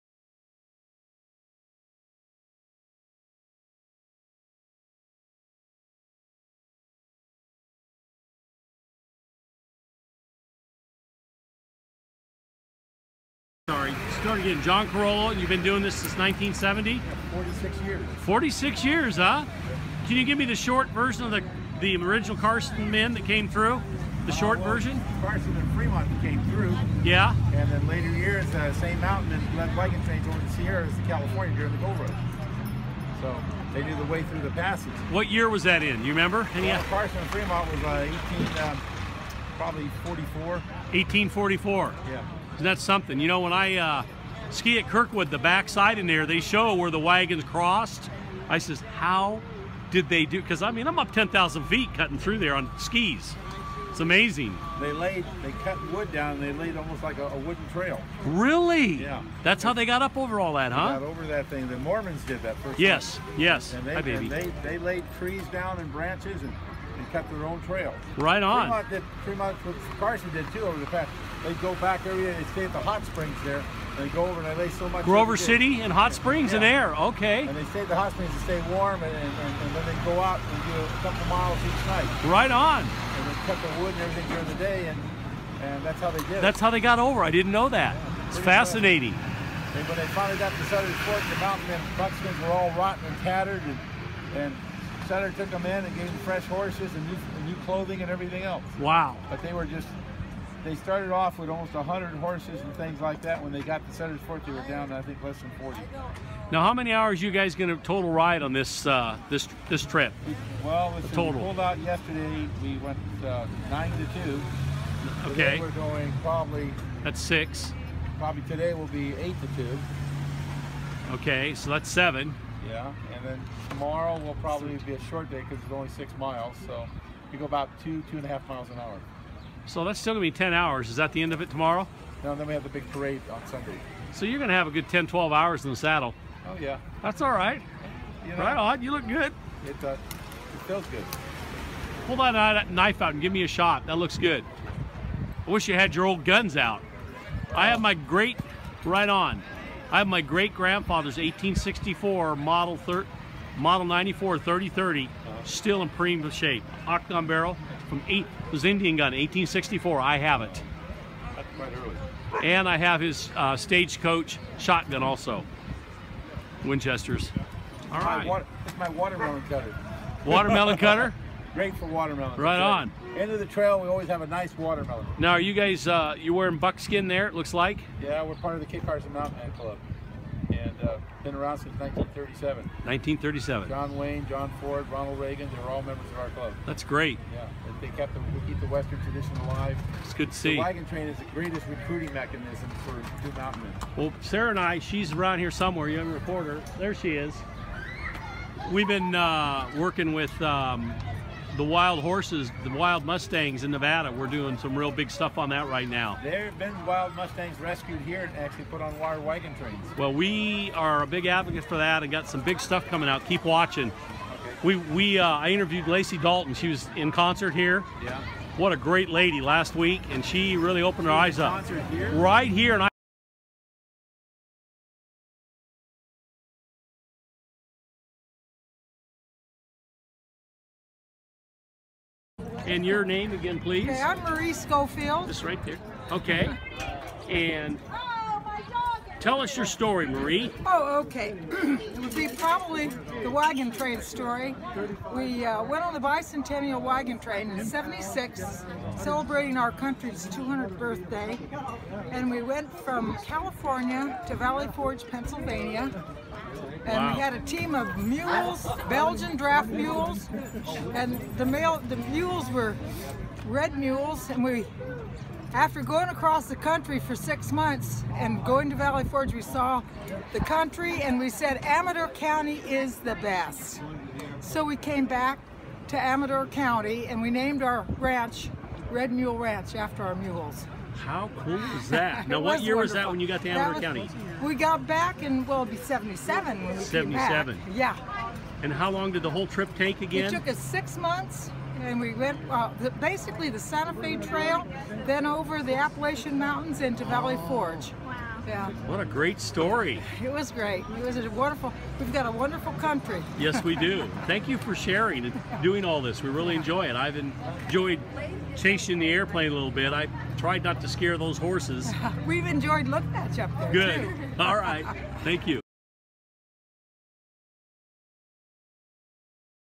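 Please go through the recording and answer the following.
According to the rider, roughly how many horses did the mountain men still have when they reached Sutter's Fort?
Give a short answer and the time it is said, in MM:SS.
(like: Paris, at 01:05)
less than 40, at 01:45.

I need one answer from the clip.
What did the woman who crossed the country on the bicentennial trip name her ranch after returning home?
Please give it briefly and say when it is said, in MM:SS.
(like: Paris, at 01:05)
Red Mule Ranch, at 04:38.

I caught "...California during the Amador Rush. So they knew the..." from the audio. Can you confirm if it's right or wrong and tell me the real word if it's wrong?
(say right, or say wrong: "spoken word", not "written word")
wrong: "Gold", not "Amador".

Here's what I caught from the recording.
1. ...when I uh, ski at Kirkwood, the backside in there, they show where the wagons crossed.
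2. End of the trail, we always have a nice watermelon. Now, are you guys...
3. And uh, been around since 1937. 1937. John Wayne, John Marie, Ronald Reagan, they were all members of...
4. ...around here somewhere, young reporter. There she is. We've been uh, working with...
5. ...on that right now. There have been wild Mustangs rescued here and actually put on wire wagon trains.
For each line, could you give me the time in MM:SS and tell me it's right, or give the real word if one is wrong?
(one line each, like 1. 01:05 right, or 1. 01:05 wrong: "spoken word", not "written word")
1. 00:43 right
2. 02:53 right
3. 03:00 wrong: "Ford", not "Marie"
4. 03:15 right
5. 03:25 right.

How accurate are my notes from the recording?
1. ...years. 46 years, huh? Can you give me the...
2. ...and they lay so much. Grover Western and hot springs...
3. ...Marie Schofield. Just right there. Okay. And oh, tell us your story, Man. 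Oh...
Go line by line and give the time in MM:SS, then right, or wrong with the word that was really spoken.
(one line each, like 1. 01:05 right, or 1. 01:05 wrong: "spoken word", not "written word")
1. 00:17 right
2. 01:14 wrong: "City", not "Western"
3. 03:54 wrong: "Marie", not "Man".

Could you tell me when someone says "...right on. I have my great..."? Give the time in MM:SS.
02:28.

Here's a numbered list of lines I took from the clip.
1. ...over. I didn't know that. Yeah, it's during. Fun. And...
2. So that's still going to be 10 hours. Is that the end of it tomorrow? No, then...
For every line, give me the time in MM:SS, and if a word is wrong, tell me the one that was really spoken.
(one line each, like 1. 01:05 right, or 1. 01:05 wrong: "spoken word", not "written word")
1. 01:26 wrong: "fascinating", not "during"
2. 02:09 right.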